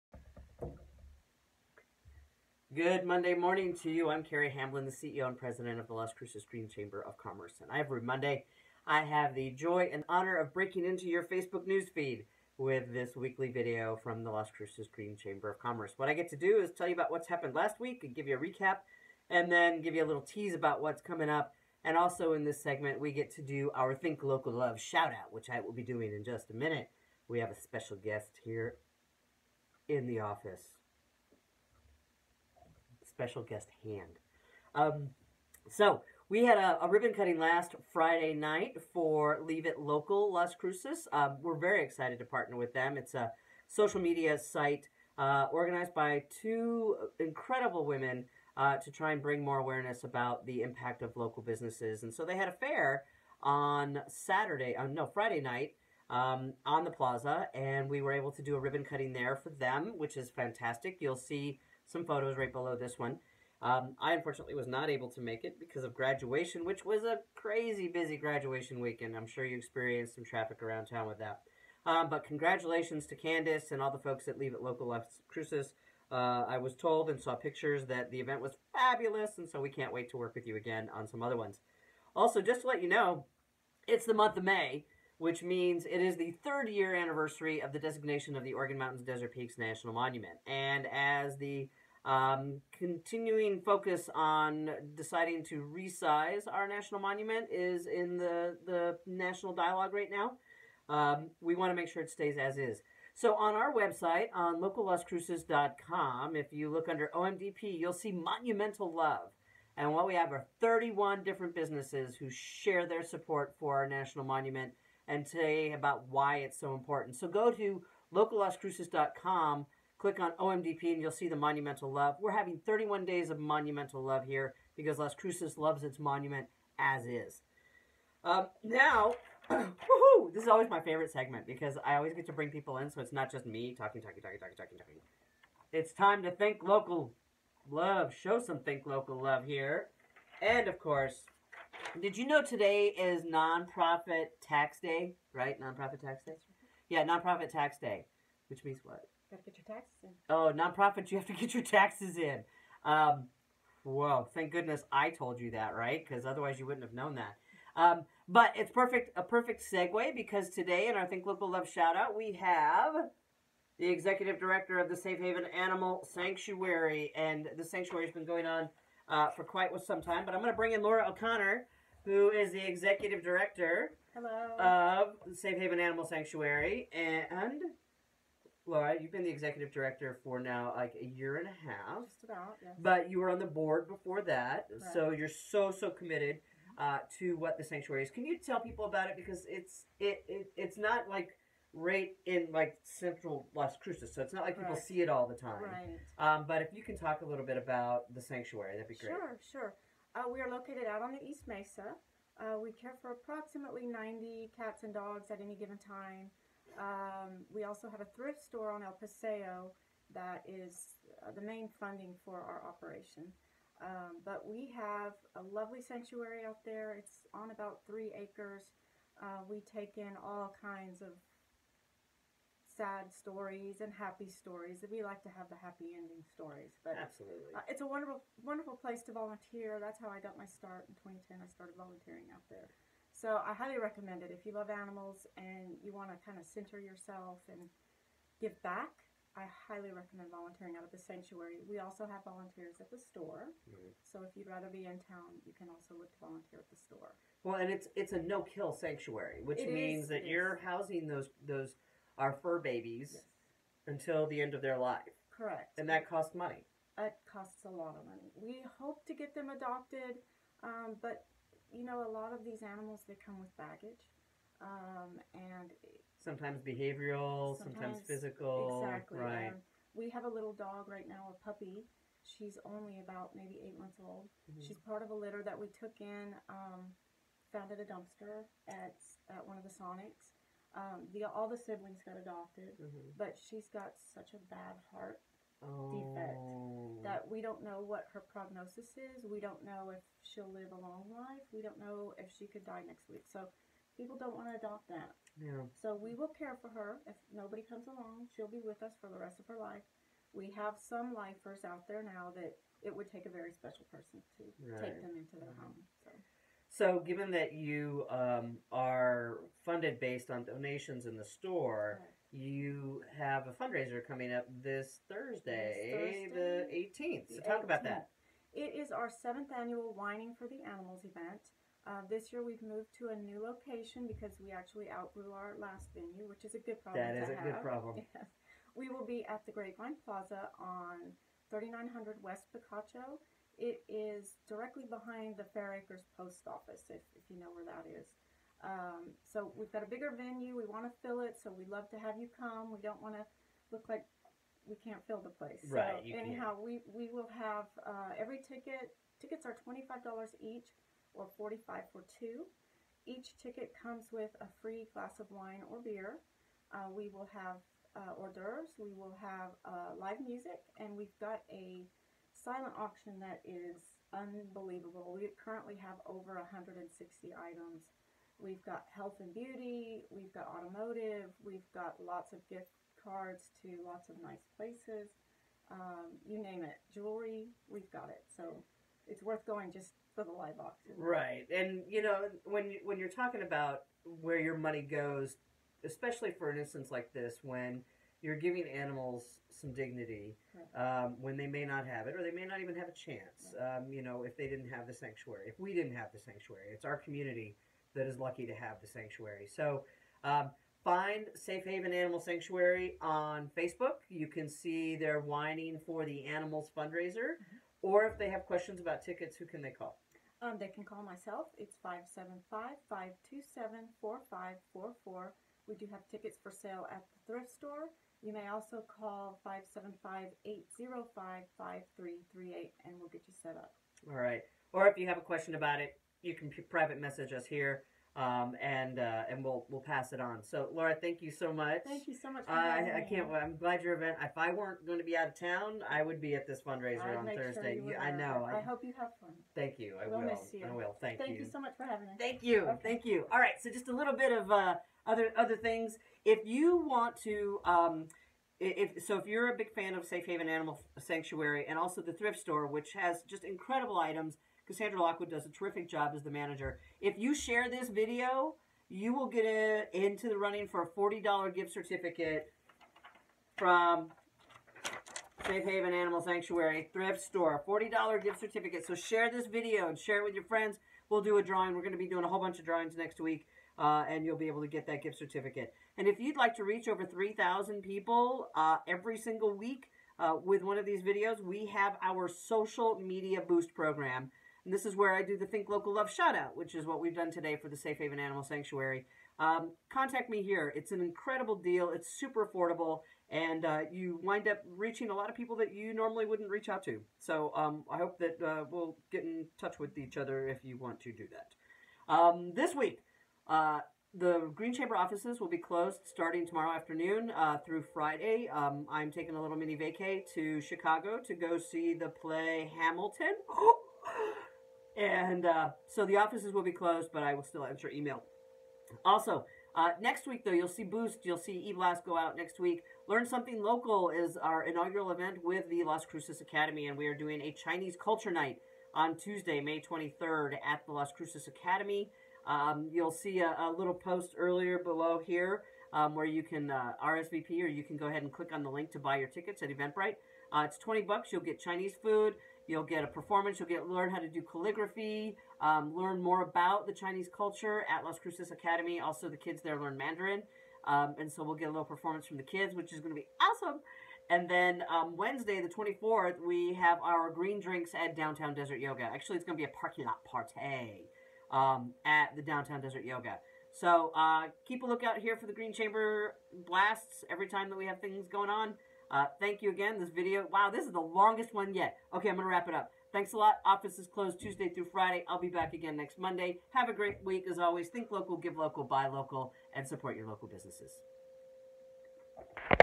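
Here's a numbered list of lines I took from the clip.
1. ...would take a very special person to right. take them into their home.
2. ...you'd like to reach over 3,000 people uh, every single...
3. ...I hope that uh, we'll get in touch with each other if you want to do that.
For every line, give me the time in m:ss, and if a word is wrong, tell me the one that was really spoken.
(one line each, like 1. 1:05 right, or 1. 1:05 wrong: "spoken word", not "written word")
1. 5:02 right
2. 7:56 right
3. 8:17 right.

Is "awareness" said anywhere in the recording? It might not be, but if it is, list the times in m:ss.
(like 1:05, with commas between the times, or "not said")
0:49.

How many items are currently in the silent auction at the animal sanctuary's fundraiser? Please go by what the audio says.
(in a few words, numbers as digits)
over 160.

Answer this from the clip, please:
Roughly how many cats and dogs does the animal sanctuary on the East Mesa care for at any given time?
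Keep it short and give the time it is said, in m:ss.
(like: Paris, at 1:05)
90, at 3:23.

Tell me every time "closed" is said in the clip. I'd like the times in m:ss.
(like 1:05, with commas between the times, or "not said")
8:25, 8:36, 9:34.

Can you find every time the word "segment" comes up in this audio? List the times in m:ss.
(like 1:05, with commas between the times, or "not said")
0:22, 2:11.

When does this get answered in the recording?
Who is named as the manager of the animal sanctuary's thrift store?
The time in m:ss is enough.
7:34.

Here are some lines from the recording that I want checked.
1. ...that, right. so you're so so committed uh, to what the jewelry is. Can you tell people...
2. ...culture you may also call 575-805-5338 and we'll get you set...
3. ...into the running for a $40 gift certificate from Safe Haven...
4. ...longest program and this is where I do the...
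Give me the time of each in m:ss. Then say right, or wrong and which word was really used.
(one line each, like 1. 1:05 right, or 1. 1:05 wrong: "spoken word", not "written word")
1. 3:04 wrong: "sanctuary", not "jewelry"
2. 6:57 wrong: "store", not "culture"
3. 7:39 right
4. 8:03 wrong: "boost", not "longest".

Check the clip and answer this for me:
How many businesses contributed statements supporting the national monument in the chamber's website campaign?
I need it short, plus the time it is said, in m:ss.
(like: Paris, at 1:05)
31, at 1:50.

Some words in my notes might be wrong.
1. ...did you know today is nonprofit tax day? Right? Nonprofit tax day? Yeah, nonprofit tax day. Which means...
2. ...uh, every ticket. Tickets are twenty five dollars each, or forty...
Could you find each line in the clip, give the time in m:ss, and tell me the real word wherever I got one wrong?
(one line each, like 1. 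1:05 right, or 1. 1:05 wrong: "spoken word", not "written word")
1. 2:22 right
2. 5:47 right.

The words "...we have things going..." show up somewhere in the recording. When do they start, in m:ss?
9:27.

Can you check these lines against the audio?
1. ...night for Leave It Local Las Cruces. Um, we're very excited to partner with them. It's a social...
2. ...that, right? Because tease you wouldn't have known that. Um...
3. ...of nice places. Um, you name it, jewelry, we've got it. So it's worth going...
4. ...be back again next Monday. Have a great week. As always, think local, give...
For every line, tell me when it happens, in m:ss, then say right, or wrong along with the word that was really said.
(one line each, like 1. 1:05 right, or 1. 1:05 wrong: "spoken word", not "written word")
1. 0:38 right
2. 2:35 wrong: "otherwise", not "tease"
3. 6:14 right
4. 9:35 right.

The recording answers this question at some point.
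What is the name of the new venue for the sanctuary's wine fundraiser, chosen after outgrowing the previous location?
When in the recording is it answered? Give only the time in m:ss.
5:29.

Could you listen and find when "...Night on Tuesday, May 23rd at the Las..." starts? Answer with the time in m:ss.
8:48.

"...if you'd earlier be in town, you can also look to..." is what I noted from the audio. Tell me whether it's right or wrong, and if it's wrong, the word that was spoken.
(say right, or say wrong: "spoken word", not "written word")
wrong: "rather", not "earlier".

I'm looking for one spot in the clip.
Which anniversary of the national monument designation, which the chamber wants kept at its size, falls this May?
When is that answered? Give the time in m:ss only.
1:26.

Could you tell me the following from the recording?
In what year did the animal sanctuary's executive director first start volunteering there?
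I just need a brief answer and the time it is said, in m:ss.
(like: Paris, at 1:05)
2010, at 3:51.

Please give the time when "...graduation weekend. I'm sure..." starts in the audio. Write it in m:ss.
1:08.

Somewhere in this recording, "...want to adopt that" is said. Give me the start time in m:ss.
4:54.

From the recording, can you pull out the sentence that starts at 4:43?
but she's got such a bad heart oh.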